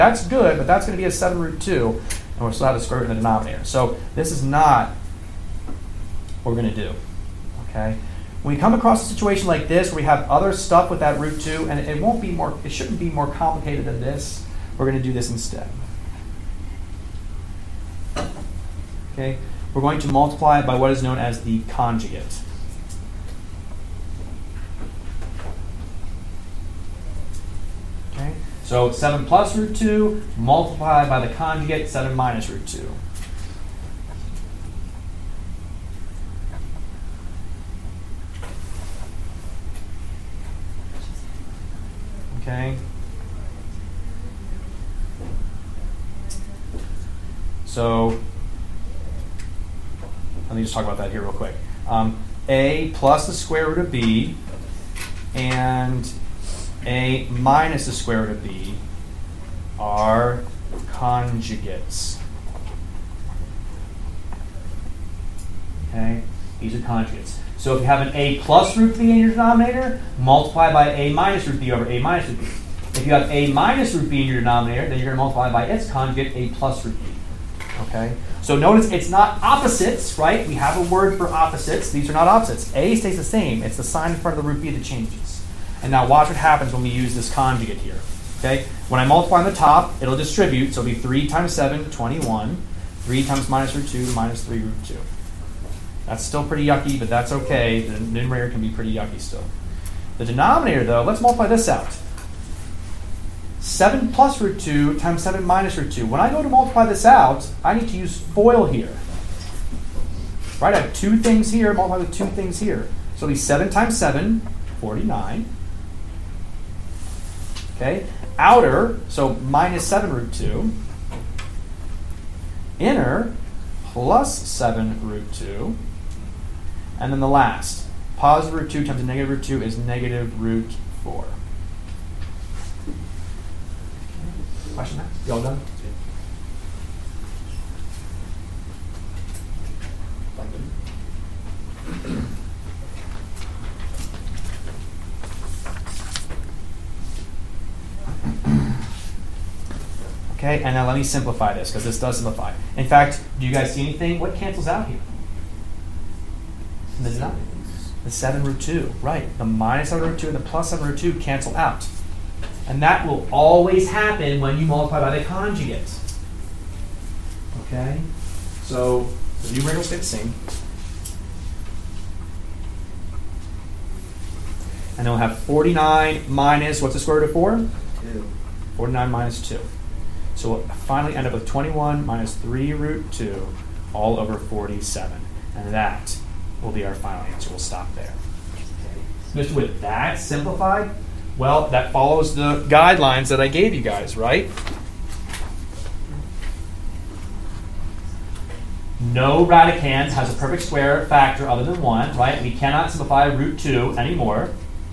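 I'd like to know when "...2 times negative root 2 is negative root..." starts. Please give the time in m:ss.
2:08.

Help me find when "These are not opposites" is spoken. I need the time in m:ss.
1:21.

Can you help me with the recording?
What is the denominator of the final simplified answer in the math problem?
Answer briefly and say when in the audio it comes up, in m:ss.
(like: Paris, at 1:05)
47, at 3:04.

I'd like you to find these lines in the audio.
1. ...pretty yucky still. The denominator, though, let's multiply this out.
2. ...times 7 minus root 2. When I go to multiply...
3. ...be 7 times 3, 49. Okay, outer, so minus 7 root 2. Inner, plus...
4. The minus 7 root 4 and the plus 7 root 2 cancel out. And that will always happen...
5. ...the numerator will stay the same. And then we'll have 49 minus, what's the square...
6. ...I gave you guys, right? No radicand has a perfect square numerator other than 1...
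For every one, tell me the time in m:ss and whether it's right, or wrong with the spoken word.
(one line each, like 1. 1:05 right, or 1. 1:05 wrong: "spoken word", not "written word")
1. 1:38 right
2. 1:44 right
3. 1:53 wrong: "7", not "3"
4. 2:39 wrong: "2", not "4"
5. 2:49 right
6. 3:13 wrong: "factor", not "numerator".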